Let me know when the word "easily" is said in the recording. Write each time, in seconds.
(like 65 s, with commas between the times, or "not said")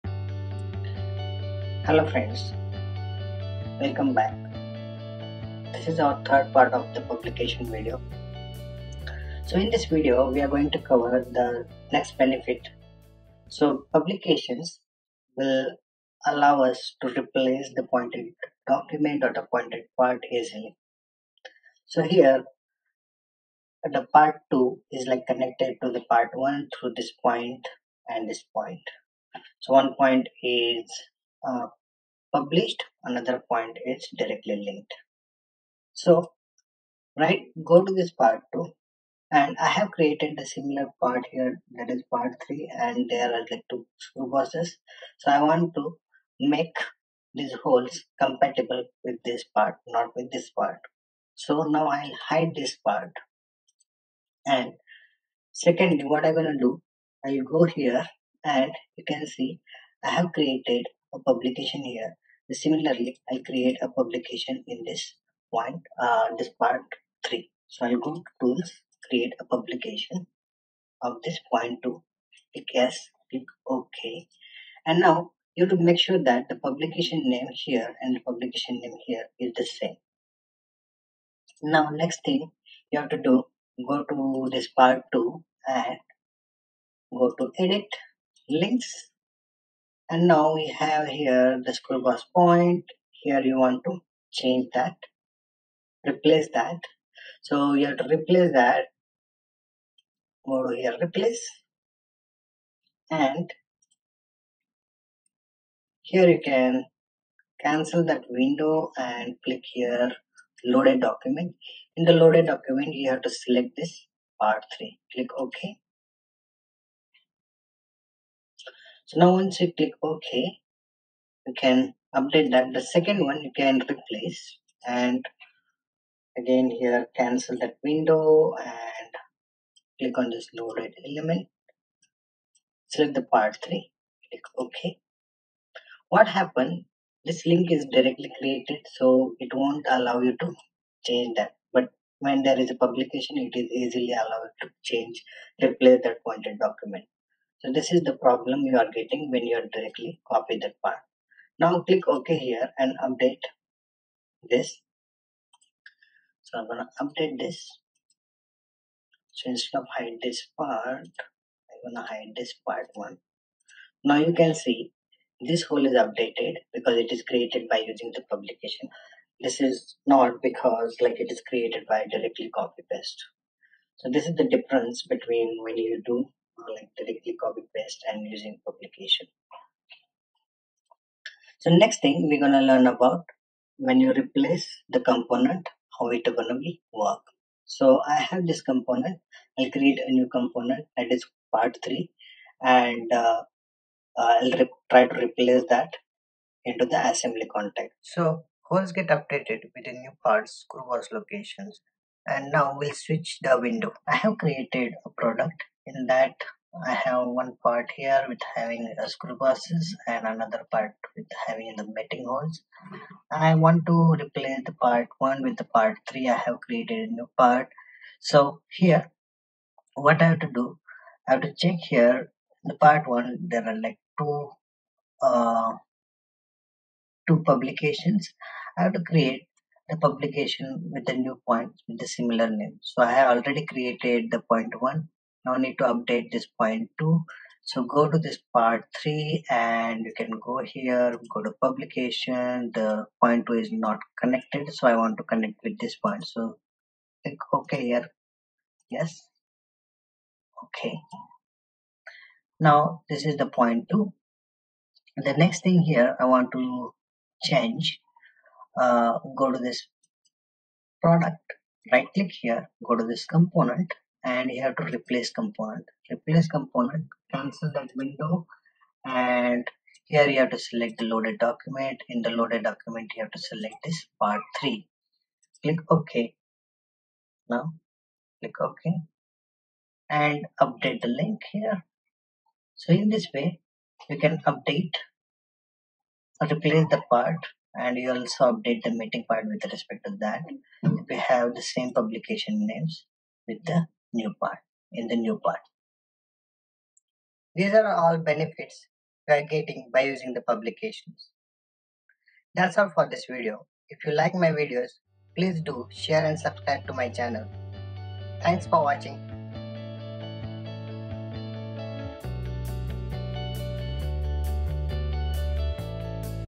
20 s, 143 s.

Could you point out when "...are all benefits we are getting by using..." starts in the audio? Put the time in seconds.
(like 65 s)
297 s.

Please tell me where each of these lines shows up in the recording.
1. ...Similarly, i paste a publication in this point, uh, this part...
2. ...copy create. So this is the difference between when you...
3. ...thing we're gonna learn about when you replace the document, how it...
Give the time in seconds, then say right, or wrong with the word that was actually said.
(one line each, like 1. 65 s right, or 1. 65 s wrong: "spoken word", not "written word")
1. 62 s wrong: "create", not "paste"
2. 172 s wrong: "paste", not "create"
3. 182 s wrong: "component", not "document".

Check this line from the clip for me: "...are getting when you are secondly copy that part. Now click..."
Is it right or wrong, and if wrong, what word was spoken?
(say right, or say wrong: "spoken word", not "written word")
wrong: "directly", not "secondly".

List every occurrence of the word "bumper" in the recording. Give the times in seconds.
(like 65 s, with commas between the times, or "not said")
not said.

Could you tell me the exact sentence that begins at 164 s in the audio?
Now you can see this hole is updated because it is created by using the publication.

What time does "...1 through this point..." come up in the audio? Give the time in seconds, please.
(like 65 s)
26 s.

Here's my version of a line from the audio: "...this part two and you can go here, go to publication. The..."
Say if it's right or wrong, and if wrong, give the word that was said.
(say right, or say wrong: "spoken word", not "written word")
wrong: "three", not "two".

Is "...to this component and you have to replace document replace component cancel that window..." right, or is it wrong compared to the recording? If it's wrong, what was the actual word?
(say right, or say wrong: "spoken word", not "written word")
wrong: "component", not "document".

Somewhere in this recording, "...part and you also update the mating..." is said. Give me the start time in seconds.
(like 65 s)
287 s.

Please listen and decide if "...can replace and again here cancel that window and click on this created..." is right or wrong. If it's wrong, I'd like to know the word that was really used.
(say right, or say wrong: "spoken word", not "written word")
wrong: "loaded", not "created".